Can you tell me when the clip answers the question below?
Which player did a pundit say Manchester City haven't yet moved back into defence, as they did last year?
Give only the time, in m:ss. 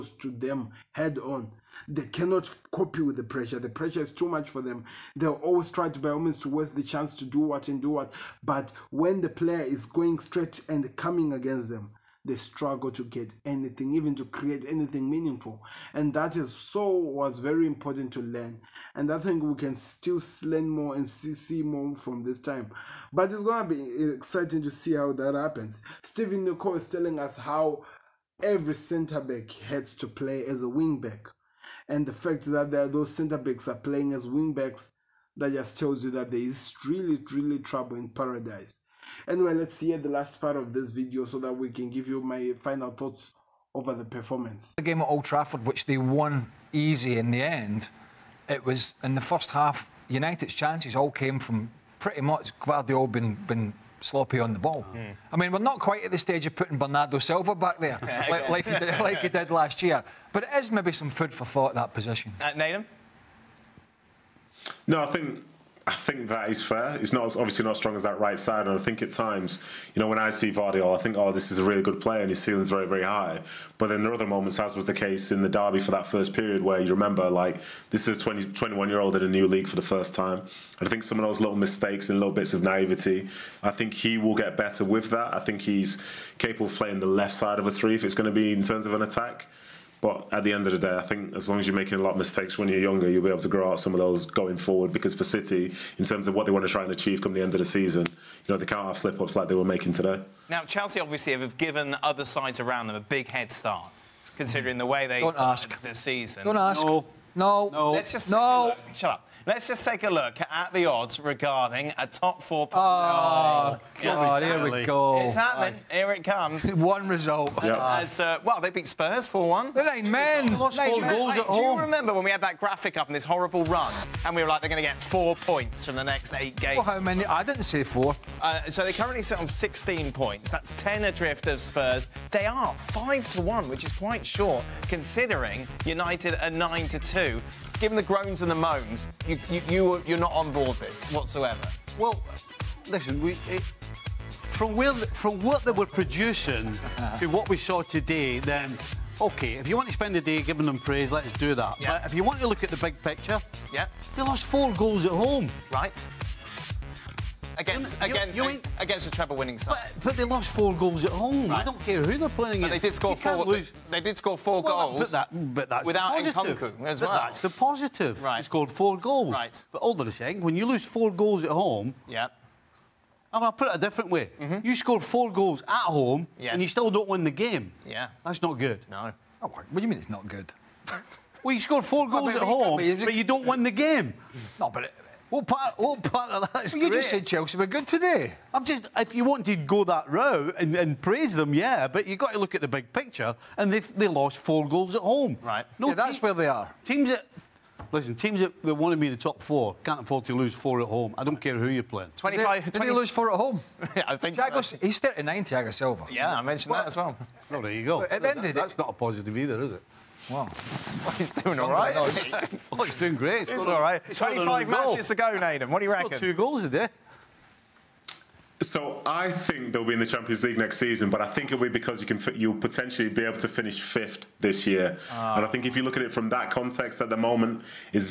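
0:56.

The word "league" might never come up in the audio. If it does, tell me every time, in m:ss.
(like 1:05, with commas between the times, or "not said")
1:19, 3:40.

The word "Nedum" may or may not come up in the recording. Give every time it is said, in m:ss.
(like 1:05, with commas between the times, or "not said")
1:02, 3:35.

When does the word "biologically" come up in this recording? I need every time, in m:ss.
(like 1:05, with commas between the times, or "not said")
not said.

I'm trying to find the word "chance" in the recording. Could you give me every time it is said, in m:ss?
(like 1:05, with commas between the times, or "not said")
0:06, 0:50.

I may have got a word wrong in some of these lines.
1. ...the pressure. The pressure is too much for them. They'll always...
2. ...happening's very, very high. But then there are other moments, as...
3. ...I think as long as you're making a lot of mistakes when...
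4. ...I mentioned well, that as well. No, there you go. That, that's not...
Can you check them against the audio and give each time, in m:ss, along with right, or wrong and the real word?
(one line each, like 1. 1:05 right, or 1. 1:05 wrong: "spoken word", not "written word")
1. 0:03 right
2. 1:12 wrong: "ceiling", not "happening"
3. 1:30 right
4. 3:26 right.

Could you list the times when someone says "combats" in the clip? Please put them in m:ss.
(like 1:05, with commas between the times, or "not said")
not said.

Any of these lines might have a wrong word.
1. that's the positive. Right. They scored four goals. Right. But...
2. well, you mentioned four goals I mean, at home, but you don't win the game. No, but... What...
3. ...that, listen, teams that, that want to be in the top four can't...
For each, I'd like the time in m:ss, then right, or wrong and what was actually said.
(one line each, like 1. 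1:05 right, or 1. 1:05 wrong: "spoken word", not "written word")
1. 2:47 right
2. 3:01 wrong: "scored", not "mentioned"
3. 3:17 right.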